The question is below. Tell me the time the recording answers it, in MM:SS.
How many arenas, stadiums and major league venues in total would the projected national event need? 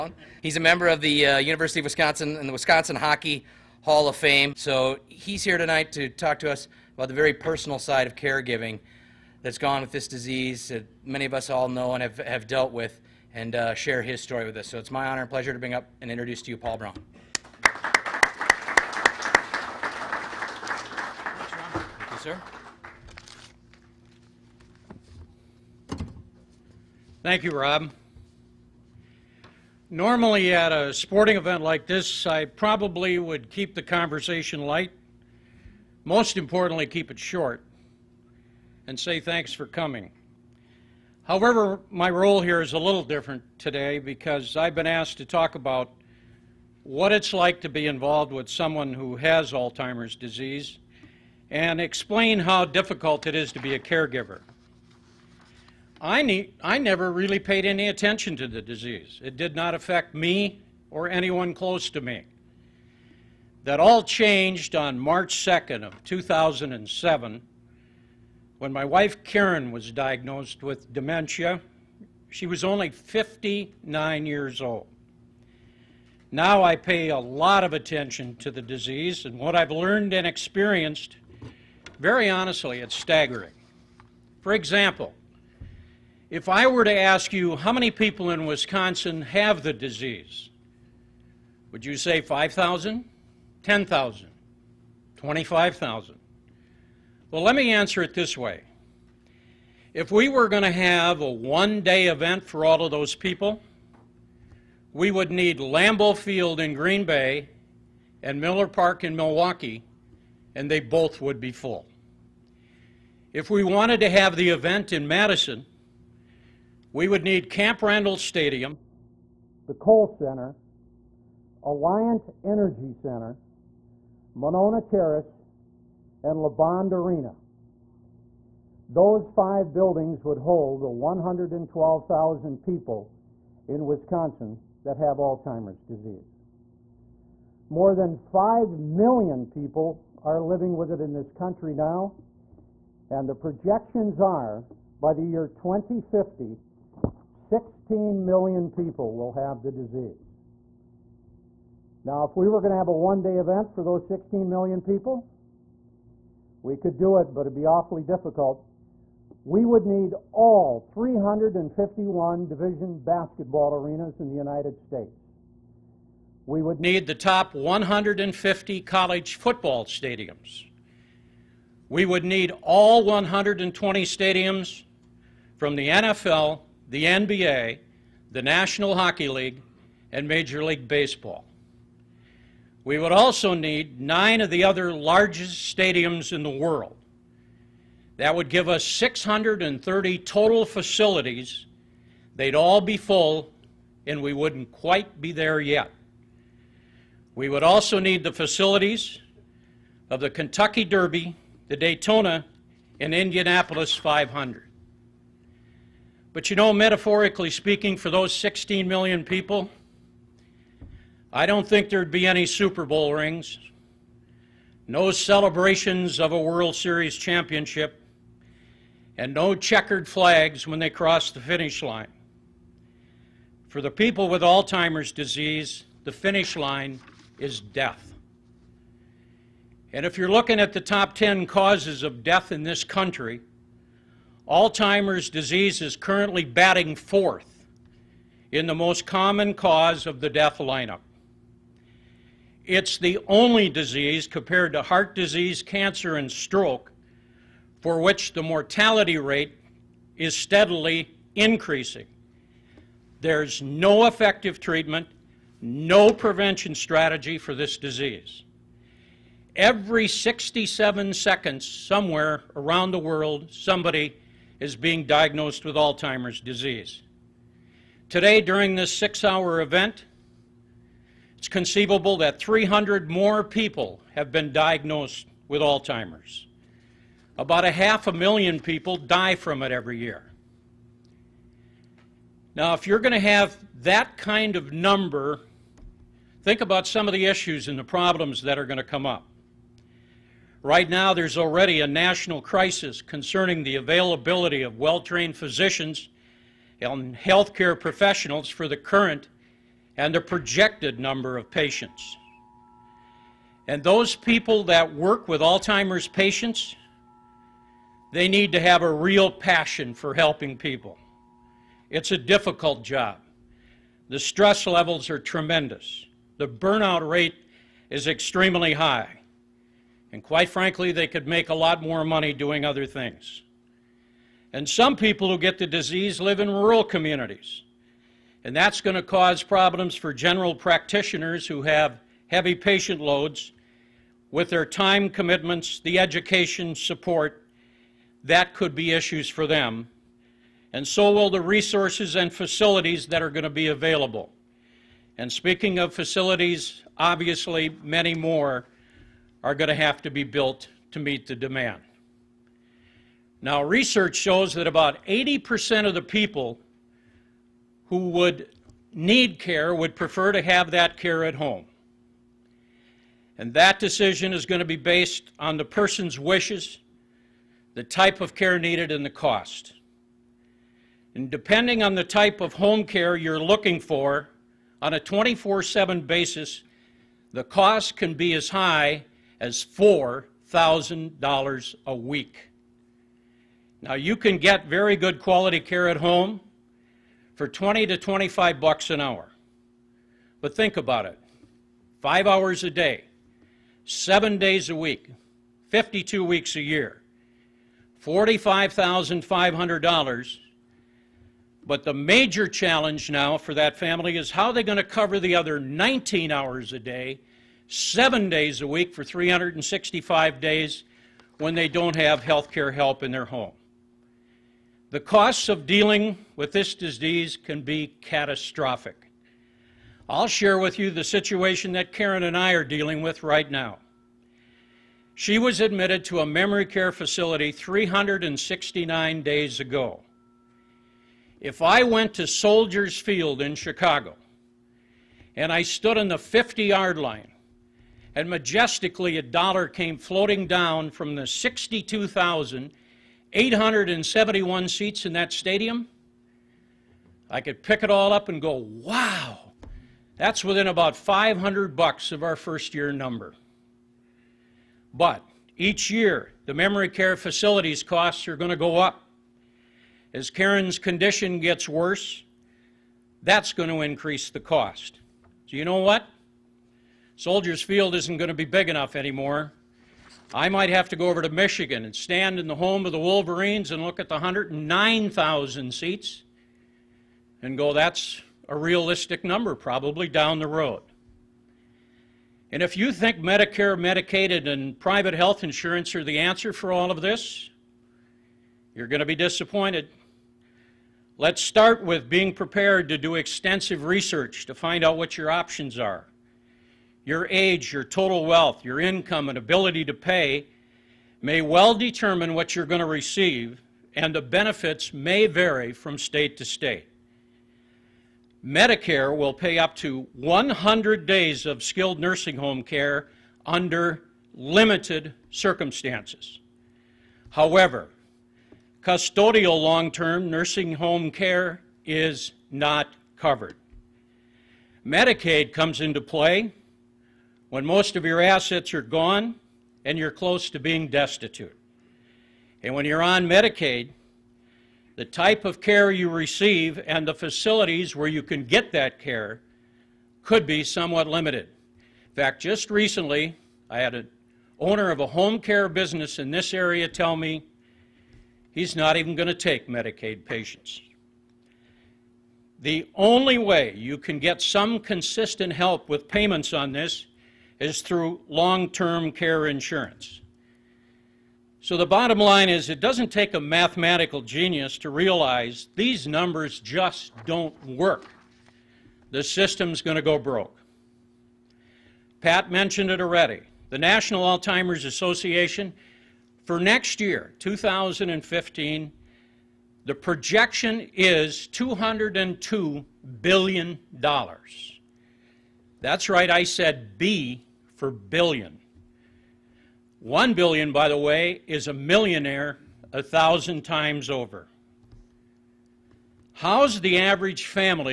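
03:08.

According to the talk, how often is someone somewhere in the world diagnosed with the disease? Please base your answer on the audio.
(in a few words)
Every 67 seconds.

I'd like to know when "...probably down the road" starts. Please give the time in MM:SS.
07:59.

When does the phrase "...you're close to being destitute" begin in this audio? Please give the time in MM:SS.
08:49.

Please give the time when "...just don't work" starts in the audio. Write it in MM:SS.
09:26.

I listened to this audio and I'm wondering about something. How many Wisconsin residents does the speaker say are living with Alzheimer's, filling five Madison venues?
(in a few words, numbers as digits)
112,000.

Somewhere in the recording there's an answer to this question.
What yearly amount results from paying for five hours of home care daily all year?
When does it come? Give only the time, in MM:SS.
06:38.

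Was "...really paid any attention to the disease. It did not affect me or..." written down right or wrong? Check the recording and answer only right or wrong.
right.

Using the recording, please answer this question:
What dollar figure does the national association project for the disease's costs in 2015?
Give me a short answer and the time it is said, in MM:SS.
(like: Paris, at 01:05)
$202 billion, at 09:41.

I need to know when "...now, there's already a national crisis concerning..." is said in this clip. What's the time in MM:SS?
04:50.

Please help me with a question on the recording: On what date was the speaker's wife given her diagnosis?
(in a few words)
March 2nd, 2007.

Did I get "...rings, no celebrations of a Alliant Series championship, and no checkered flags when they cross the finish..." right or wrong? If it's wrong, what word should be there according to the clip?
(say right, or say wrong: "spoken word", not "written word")
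wrong: "World", not "Alliant".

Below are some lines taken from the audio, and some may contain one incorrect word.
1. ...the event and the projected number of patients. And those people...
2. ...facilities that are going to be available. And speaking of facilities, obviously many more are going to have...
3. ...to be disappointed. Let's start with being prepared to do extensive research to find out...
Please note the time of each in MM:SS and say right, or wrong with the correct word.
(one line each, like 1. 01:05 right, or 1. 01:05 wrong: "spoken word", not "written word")
1. 04:58 wrong: "current", not "event"
2. 05:42 right
3. 08:09 right.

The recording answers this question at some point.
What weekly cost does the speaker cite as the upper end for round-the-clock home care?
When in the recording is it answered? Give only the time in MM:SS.
06:19.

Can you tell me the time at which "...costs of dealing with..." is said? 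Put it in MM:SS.
06:55.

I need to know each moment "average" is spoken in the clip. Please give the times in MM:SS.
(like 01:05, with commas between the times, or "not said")
09:56.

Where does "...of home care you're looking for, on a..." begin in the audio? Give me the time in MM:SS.
06:12.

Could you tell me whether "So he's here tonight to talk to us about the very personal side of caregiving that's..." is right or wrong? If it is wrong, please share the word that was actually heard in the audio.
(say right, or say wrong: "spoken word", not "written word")
right.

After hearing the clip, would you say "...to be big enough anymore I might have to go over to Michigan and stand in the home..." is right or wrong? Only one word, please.
right.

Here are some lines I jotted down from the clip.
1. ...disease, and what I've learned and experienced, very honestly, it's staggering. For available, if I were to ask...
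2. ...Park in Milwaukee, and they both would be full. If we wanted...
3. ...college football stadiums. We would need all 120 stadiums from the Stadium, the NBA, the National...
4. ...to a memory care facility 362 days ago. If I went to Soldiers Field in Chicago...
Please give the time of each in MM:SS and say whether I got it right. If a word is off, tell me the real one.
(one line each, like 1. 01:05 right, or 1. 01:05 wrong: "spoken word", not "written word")
1. 01:18 wrong: "example", not "available"
2. 01:48 right
3. 02:48 wrong: "NFL", not "Stadium"
4. 07:06 wrong: "369", not "362".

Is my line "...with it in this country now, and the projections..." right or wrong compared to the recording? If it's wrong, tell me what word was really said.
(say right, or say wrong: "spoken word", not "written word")
right.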